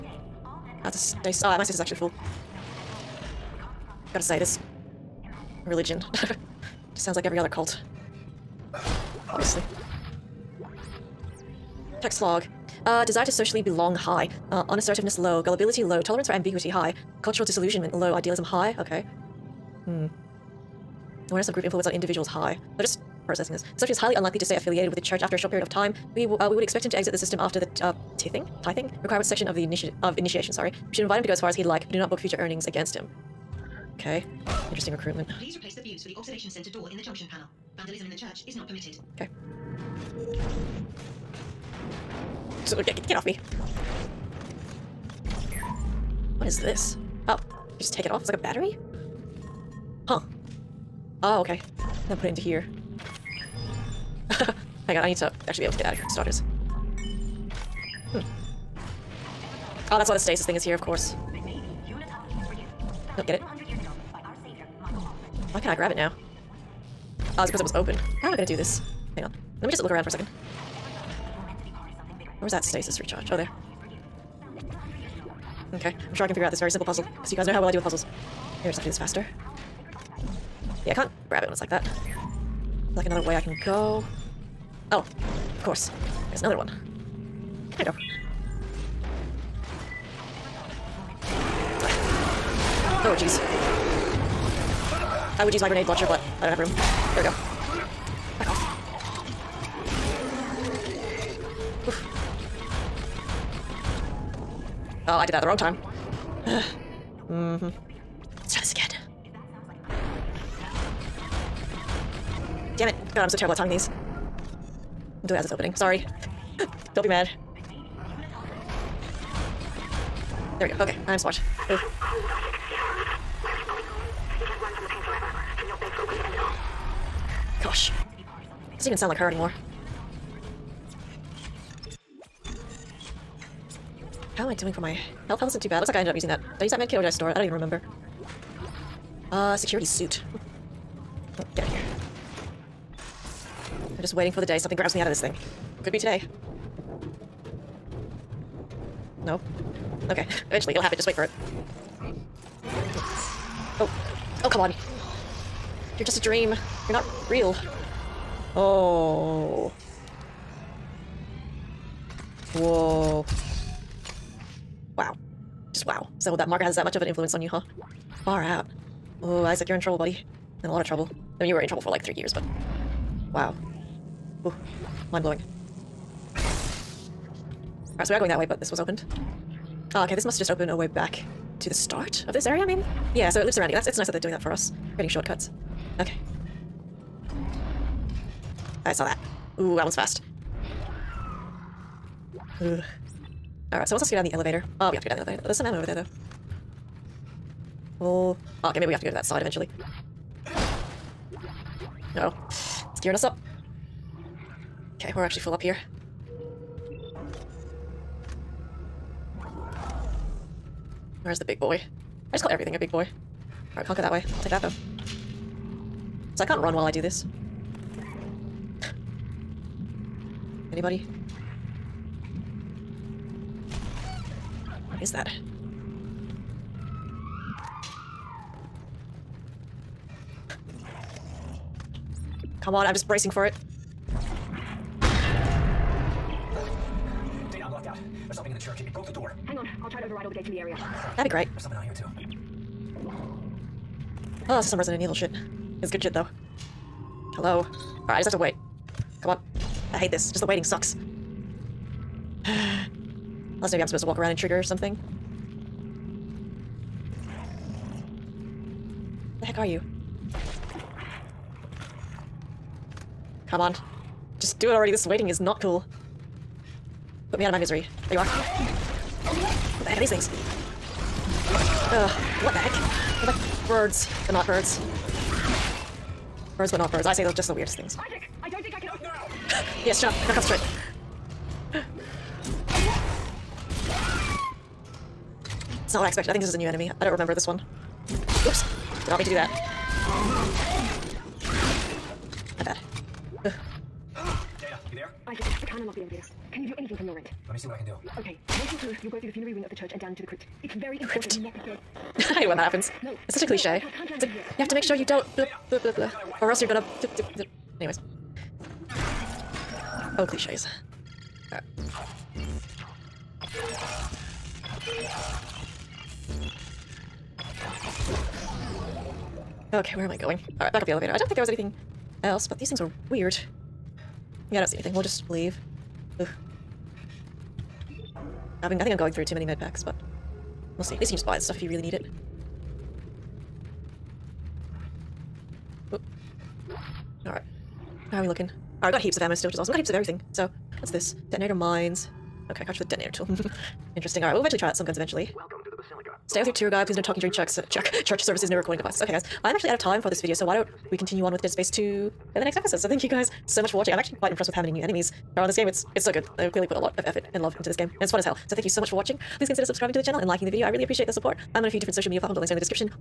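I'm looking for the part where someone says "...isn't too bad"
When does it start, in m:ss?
2:15.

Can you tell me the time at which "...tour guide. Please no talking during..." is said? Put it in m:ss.
5:46.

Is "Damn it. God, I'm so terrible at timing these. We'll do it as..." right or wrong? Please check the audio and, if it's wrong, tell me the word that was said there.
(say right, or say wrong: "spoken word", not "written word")
right.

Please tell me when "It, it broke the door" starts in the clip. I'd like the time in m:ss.
3:58.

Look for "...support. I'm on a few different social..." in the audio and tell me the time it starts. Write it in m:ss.
6:01.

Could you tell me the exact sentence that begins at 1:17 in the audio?
Because you guys know how well I do with puzzles.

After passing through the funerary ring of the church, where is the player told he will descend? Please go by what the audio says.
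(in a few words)
The crypt.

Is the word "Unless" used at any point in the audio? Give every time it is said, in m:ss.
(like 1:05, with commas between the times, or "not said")
4:13.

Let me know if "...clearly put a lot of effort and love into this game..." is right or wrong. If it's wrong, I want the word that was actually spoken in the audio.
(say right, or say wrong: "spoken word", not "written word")
right.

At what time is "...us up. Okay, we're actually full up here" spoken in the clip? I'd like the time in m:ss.
3:23.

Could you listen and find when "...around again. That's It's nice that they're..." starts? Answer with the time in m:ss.
3:03.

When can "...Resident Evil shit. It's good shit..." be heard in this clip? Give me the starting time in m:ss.
4:04.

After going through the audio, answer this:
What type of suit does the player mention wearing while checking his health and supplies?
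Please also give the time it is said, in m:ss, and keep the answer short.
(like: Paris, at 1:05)
Security suit, at 2:19.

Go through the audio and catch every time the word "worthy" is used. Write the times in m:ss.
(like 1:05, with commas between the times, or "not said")
not said.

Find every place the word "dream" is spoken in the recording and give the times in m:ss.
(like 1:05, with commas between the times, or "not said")
2:36.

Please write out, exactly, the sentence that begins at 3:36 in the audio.
So I can't run while I do this.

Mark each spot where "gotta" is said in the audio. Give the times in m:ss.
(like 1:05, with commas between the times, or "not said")
0:04, 4:40.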